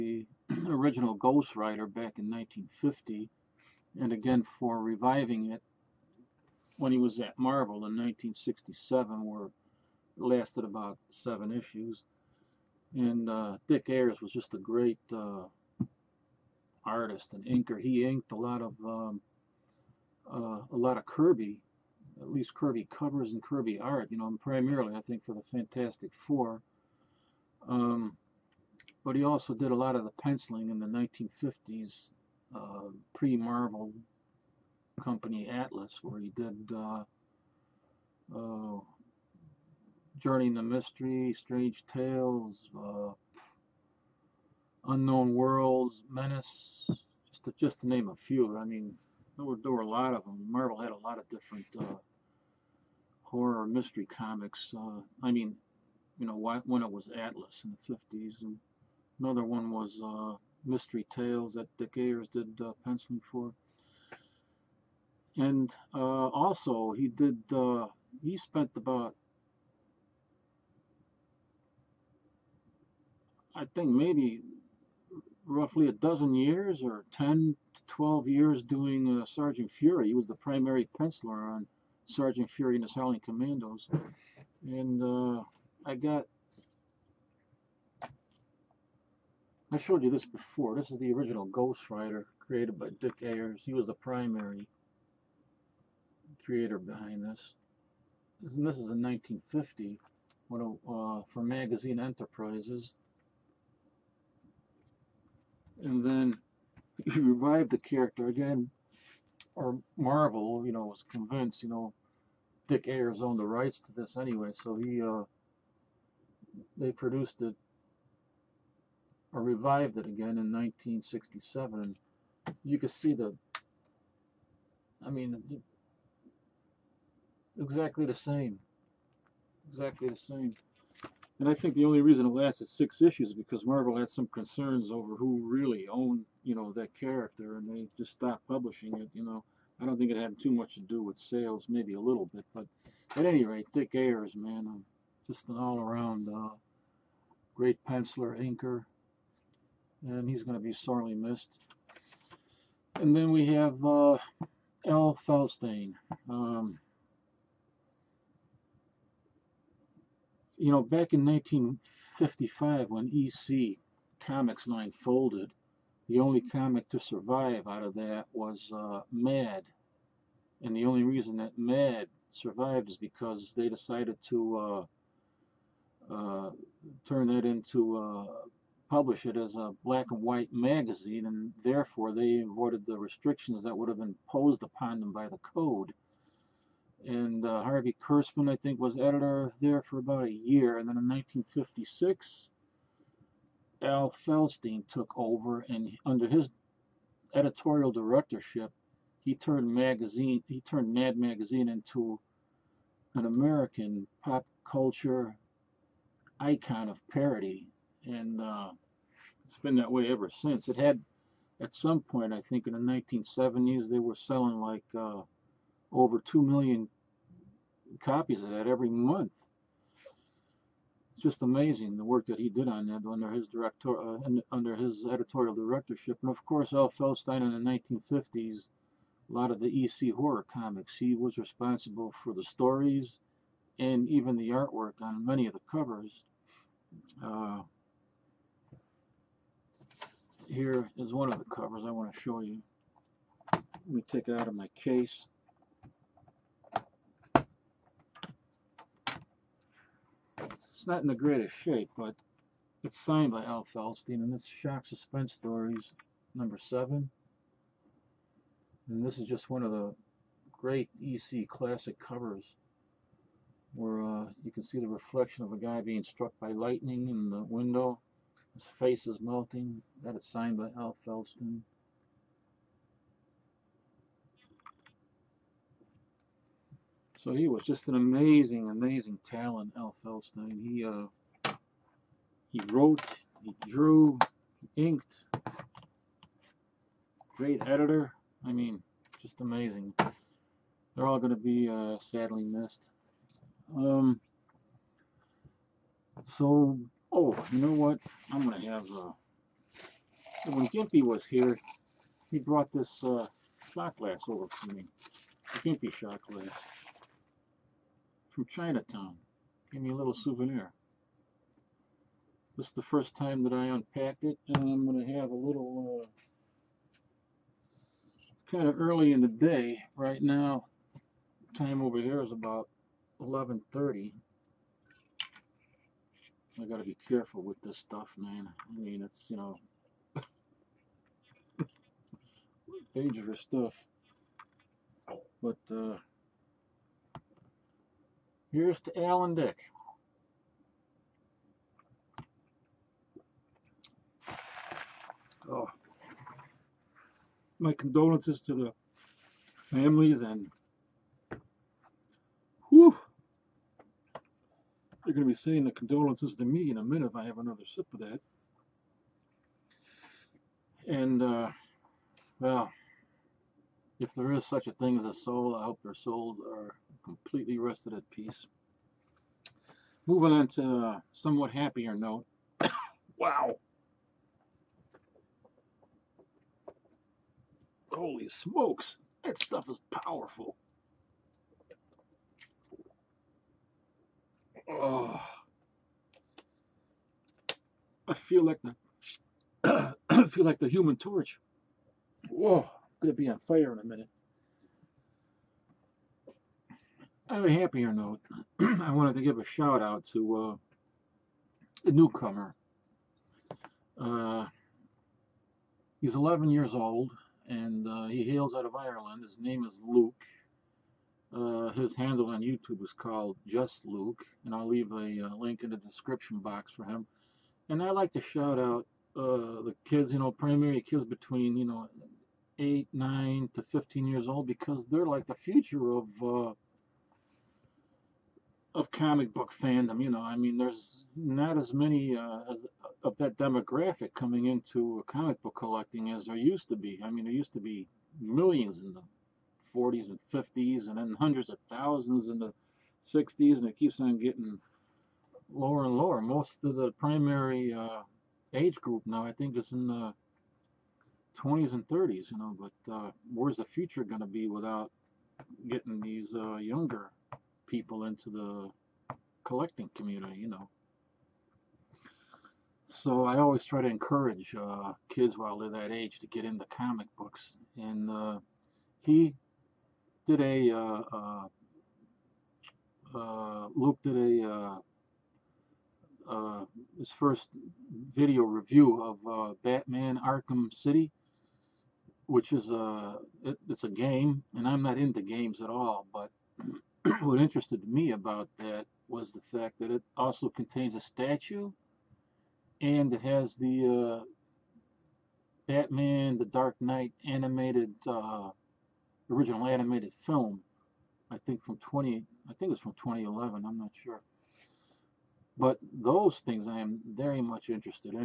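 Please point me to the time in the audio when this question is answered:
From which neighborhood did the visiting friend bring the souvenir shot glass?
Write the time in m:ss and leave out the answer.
5:08.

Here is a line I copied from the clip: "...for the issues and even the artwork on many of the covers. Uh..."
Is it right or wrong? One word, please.
wrong.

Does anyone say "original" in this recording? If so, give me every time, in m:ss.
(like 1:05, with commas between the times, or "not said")
0:00, 1:31, 8:19.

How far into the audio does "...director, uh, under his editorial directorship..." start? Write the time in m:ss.
3:43.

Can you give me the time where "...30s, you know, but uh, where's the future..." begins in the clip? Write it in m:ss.
7:31.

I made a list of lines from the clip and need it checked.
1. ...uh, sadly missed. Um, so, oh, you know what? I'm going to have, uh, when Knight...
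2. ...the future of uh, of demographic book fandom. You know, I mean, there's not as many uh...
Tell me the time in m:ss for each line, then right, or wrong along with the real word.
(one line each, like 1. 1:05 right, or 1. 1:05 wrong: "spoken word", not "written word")
1. 4:51 wrong: "Gimpy", not "Knight"
2. 7:05 wrong: "comic", not "demographic".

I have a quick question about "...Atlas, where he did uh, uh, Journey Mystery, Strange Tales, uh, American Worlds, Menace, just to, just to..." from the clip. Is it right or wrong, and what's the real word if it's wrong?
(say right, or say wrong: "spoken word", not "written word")
wrong: "Unknown", not "American".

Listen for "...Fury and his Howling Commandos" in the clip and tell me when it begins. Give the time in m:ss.
1:22.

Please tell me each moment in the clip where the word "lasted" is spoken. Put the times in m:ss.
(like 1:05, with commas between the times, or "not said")
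0:10, 2:12.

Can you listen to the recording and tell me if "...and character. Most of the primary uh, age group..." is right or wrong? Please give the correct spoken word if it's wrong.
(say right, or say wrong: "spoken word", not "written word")
wrong: "lower", not "character".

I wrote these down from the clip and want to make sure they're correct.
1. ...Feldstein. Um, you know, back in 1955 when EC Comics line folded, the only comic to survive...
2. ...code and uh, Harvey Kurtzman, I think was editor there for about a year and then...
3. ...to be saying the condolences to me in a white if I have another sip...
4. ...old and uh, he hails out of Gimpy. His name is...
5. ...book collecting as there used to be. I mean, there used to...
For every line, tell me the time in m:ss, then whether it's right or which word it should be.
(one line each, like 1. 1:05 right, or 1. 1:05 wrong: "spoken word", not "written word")
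1. 2:35 right
2. 3:05 right
3. 5:55 wrong: "minute", not "white"
4. 6:46 wrong: "Ireland", not "Gimpy"
5. 7:15 right.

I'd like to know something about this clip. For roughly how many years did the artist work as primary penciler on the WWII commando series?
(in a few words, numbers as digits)
10 to 12.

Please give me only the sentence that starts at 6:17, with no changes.
Holy smokes, that stuff is powerful.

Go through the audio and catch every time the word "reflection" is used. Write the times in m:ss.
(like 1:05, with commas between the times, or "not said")
4:24.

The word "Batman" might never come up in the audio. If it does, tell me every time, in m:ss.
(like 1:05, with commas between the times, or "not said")
7:59, 8:15.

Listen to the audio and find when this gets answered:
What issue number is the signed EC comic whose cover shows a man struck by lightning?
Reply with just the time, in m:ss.
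4:16.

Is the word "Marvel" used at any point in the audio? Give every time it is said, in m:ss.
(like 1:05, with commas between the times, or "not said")
0:07, 0:33, 0:50, 1:49, 2:13.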